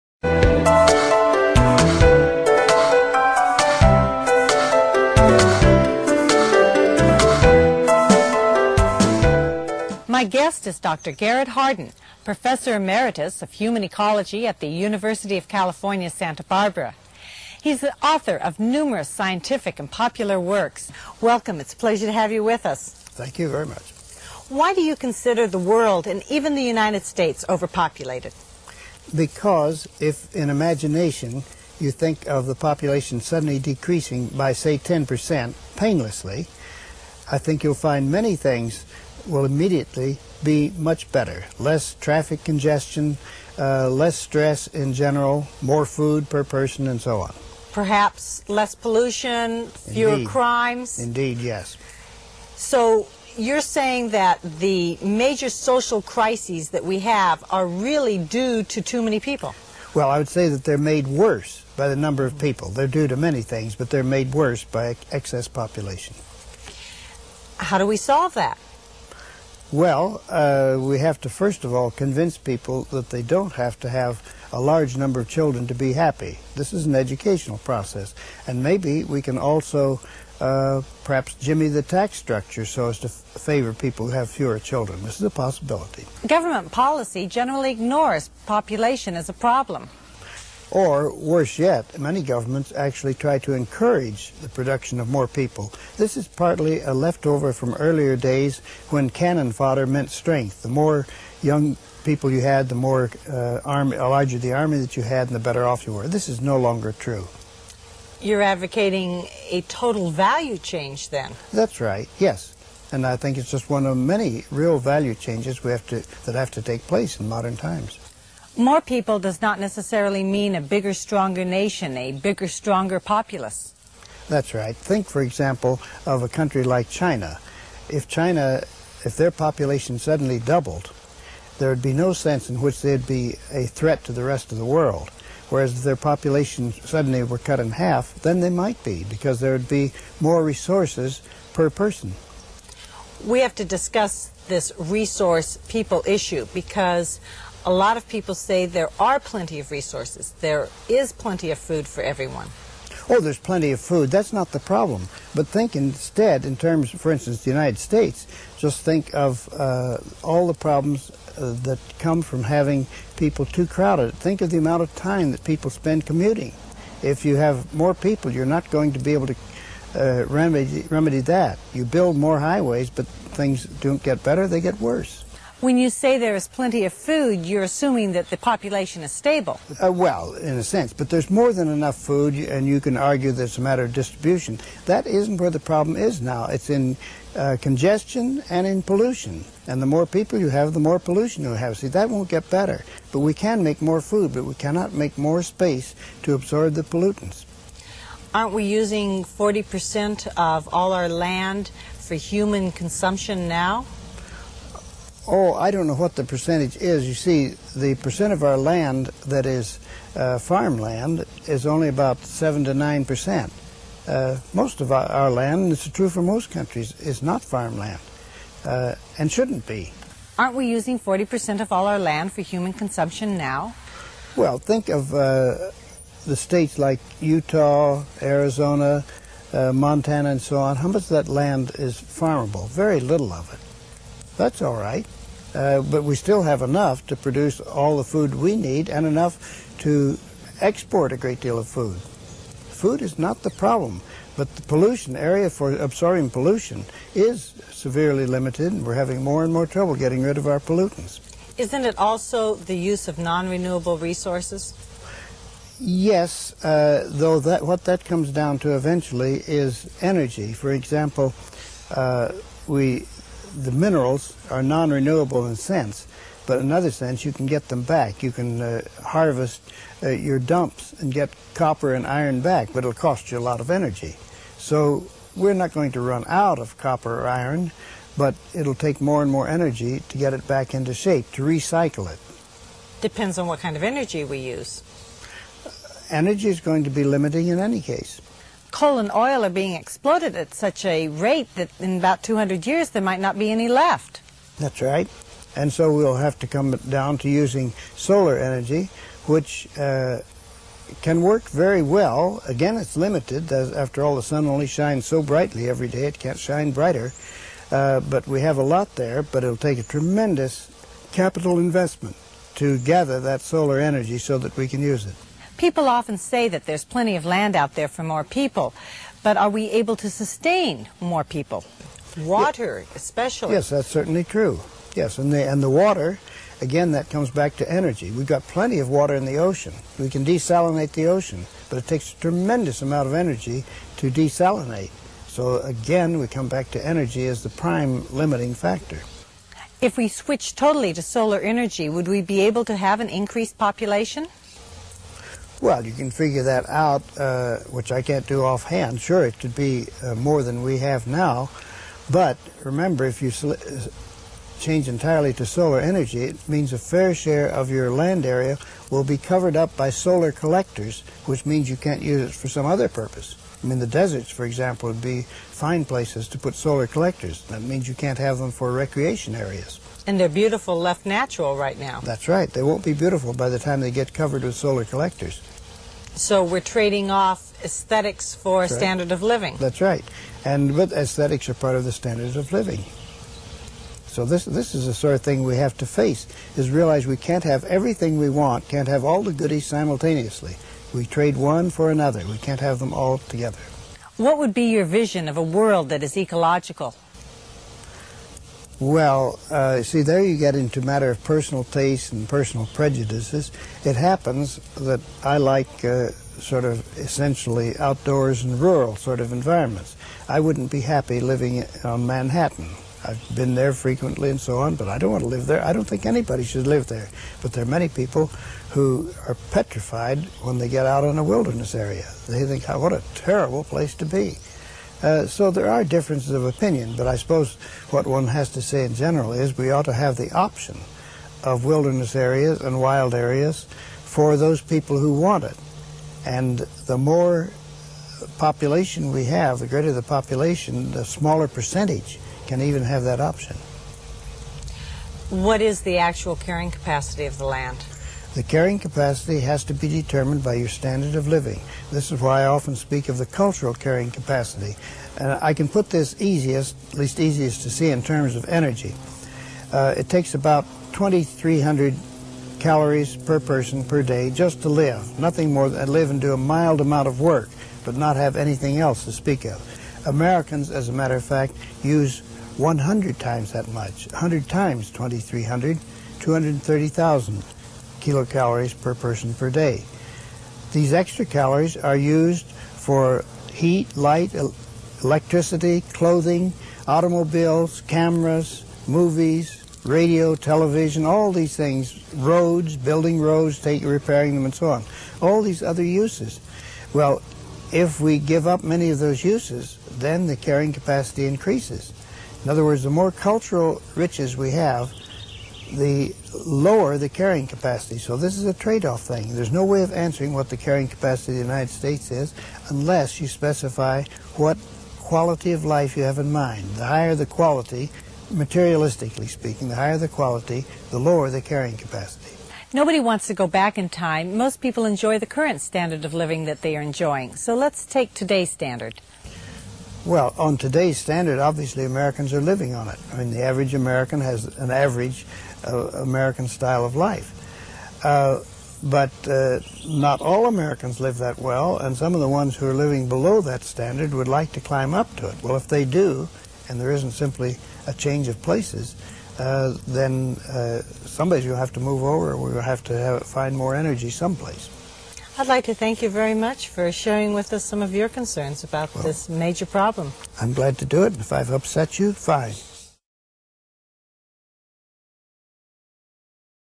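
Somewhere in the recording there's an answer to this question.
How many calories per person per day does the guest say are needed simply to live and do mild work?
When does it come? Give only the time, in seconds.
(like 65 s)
460 s.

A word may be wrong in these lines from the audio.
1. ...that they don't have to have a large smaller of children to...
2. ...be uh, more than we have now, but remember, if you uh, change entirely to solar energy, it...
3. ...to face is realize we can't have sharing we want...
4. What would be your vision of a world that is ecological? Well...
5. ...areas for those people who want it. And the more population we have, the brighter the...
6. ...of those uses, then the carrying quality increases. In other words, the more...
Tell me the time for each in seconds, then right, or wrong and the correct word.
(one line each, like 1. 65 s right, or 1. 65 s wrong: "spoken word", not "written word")
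1. 72 s wrong: "number", not "smaller"
2. 349 s right
3. 385 s wrong: "everything", not "sharing"
4. 394 s right
5. 433 s wrong: "greater", not "brighter"
6. 498 s wrong: "capacity", not "quality".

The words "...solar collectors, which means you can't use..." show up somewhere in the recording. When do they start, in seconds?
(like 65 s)
359 s.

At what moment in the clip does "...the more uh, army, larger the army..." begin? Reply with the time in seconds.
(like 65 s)
102 s.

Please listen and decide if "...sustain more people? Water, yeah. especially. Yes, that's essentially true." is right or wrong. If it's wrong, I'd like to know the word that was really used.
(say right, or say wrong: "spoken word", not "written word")
wrong: "certainly", not "essentially".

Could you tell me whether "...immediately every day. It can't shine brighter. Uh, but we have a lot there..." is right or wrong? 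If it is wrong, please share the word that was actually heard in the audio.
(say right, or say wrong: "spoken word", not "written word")
wrong: "brightly", not "immediately".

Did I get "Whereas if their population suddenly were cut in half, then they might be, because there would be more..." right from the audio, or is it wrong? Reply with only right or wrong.
right.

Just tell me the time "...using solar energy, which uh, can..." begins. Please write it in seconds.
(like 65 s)
297 s.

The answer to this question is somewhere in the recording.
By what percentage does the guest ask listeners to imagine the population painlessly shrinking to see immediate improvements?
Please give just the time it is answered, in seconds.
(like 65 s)
34 s.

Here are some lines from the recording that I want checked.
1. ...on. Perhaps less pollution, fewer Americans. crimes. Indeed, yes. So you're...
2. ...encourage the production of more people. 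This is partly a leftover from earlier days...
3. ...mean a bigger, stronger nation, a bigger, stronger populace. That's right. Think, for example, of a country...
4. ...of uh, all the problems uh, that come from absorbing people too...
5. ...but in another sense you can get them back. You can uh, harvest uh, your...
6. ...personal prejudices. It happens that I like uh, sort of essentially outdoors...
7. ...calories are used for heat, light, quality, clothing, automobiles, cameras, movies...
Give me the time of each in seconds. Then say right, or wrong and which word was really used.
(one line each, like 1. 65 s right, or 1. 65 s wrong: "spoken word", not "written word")
1. 47 s wrong: "Indeed", not "Americans"
2. 93 s right
3. 120 s right
4. 159 s wrong: "having", not "absorbing"
5. 266 s right
6. 402 s right
7. 481 s wrong: "electricity", not "quality".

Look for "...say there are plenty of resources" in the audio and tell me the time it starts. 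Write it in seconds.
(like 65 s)
148 s.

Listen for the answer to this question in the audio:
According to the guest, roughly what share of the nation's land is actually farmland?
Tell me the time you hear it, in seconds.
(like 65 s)
212 s.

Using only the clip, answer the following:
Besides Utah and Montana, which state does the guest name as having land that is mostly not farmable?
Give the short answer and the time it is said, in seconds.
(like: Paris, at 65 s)
Arizona, at 228 s.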